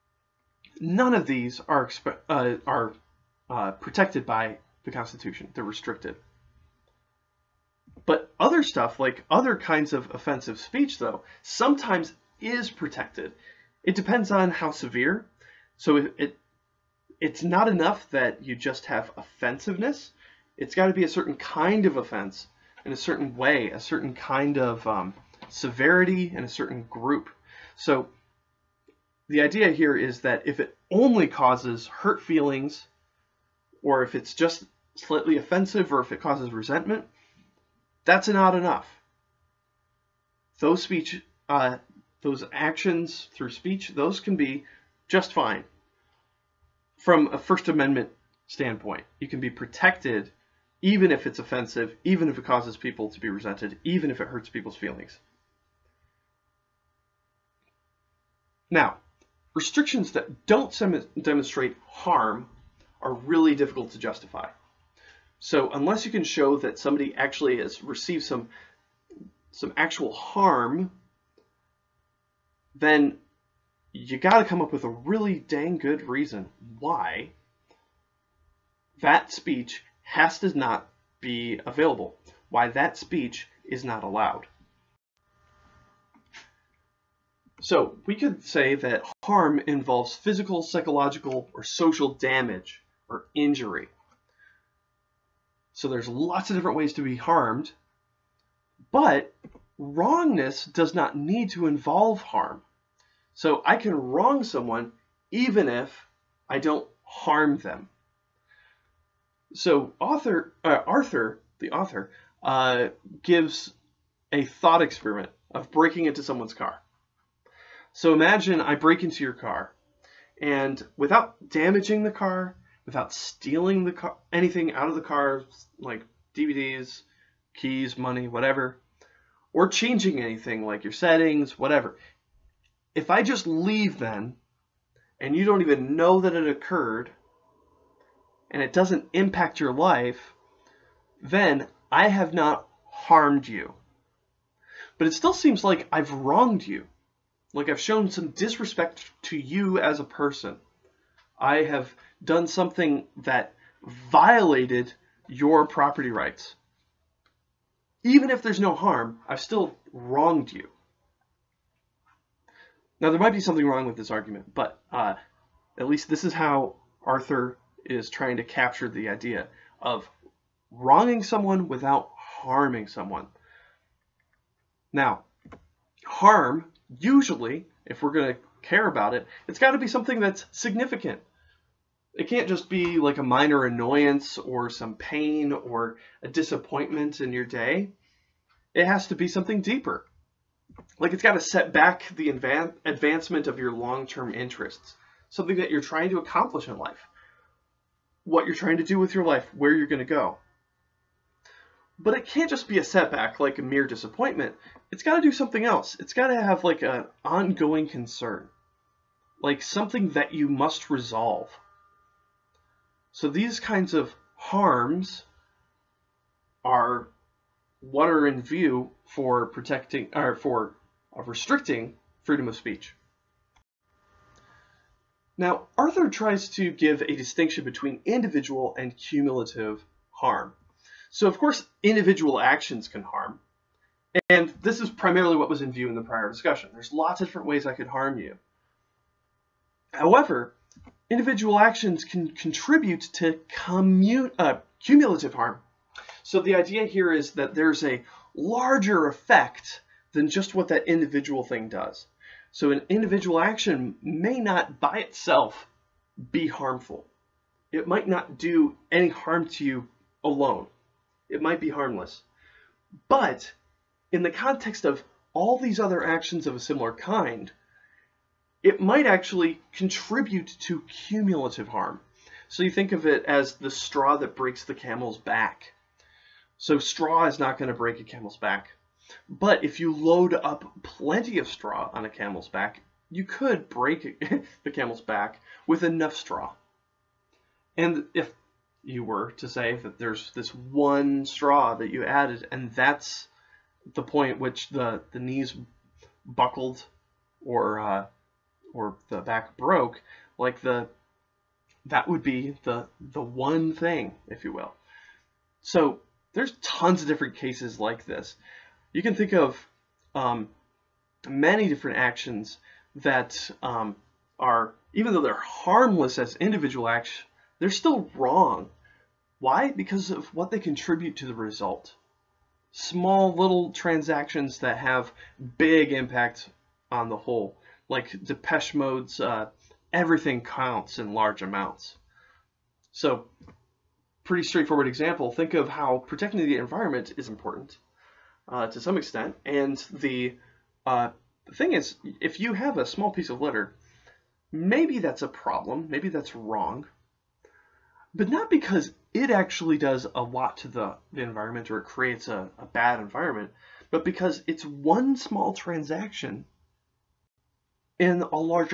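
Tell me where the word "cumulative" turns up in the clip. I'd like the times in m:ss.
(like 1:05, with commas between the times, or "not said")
3:48, 4:04, 4:30.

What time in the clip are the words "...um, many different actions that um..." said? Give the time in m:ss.
5:10.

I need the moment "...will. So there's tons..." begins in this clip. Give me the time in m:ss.
5:04.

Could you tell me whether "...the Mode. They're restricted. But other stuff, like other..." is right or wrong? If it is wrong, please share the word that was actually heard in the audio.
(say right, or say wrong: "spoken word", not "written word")
wrong: "Constitution", not "Mode".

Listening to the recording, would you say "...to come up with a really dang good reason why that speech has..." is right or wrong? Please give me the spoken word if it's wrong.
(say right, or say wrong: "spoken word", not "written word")
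right.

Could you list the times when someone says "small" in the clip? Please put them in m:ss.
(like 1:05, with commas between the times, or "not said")
5:22, 5:42, 5:55.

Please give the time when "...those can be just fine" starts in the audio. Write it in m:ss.
0:43.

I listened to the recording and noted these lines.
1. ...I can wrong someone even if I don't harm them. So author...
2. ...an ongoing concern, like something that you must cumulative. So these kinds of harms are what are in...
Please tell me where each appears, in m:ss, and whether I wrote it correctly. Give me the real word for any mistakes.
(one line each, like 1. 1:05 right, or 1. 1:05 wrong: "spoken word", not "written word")
1. 1:43 right
2. 3:26 wrong: "resolve", not "cumulative".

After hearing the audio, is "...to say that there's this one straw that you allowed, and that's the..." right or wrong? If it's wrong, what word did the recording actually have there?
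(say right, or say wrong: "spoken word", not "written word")
wrong: "added", not "allowed".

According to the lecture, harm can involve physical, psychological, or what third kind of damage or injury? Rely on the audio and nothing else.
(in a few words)
social.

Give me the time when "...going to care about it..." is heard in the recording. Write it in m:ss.
2:58.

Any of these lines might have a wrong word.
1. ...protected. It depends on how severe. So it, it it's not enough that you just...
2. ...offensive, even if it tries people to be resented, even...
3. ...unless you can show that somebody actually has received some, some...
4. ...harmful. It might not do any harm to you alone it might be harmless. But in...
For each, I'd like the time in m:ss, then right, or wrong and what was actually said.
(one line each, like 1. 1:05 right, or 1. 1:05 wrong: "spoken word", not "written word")
1. 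0:12 right
2. 0:51 wrong: "causes", not "tries"
3. 1:05 right
4. 4:16 right.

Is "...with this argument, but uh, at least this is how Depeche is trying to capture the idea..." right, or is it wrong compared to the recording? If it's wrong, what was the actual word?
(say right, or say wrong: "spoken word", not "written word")
wrong: "Arthur", not "Depeche".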